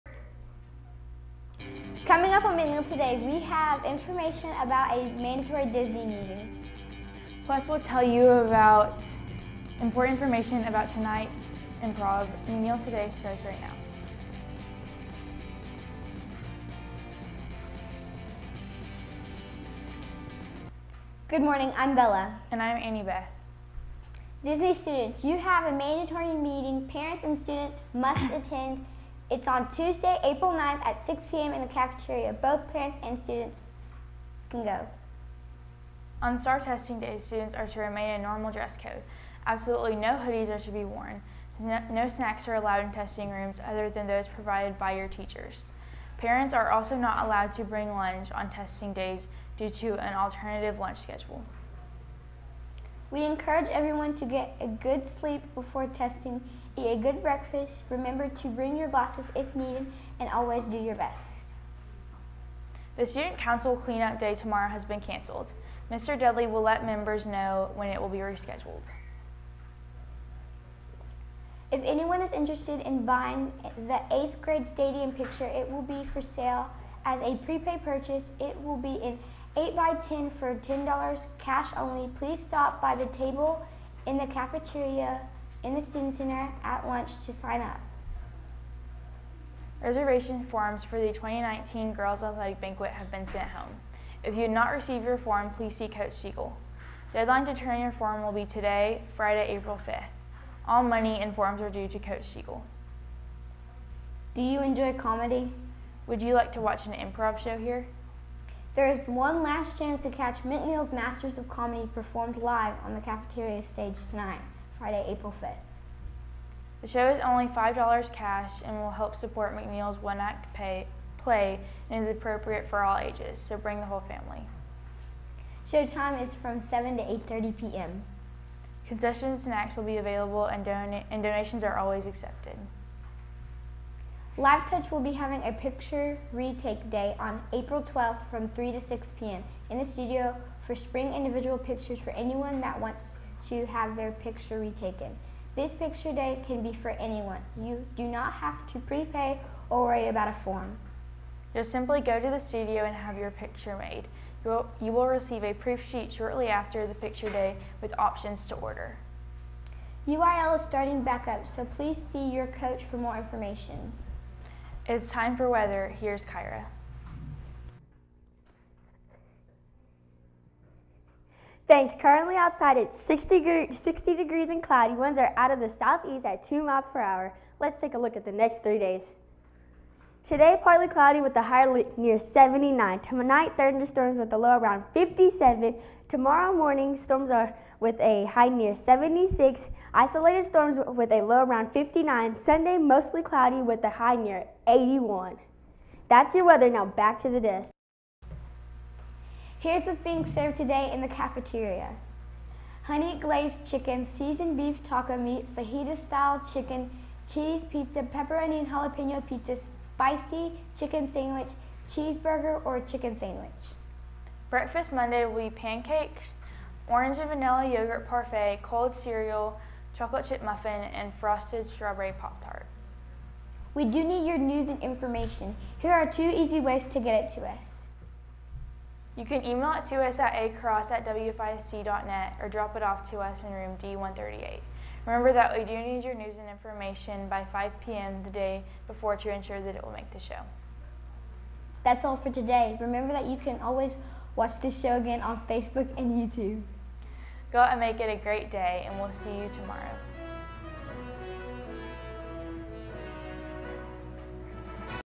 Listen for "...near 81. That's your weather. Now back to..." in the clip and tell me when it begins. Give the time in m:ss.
3:14.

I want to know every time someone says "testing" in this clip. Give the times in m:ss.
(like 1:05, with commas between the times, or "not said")
0:36, 0:42, 0:48, 0:55.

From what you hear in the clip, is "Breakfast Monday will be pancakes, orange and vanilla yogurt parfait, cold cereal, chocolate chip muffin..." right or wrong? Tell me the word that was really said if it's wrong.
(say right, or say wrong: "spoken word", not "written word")
right.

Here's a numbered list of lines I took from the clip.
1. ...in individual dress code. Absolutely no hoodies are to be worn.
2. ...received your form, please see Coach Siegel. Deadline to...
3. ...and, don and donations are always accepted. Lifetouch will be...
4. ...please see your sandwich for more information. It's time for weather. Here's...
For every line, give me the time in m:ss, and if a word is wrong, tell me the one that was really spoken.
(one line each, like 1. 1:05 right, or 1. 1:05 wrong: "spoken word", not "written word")
1. 0:38 wrong: "normal", not "individual"
2. 1:34 right
3. 2:10 right
4. 2:41 wrong: "coach", not "sandwich".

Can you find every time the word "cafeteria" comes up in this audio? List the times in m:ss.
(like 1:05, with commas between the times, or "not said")
0:31, 1:24, 1:53, 3:21.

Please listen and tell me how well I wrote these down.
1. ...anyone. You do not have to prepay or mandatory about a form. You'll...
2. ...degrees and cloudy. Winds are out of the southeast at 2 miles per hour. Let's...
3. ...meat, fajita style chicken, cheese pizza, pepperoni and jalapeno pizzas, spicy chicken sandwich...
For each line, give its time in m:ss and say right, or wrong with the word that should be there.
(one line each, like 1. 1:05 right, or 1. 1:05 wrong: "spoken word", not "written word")
1. 2:26 wrong: "worry", not "mandatory"
2. 2:54 right
3. 3:25 right.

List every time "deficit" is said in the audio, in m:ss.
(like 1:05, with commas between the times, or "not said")
not said.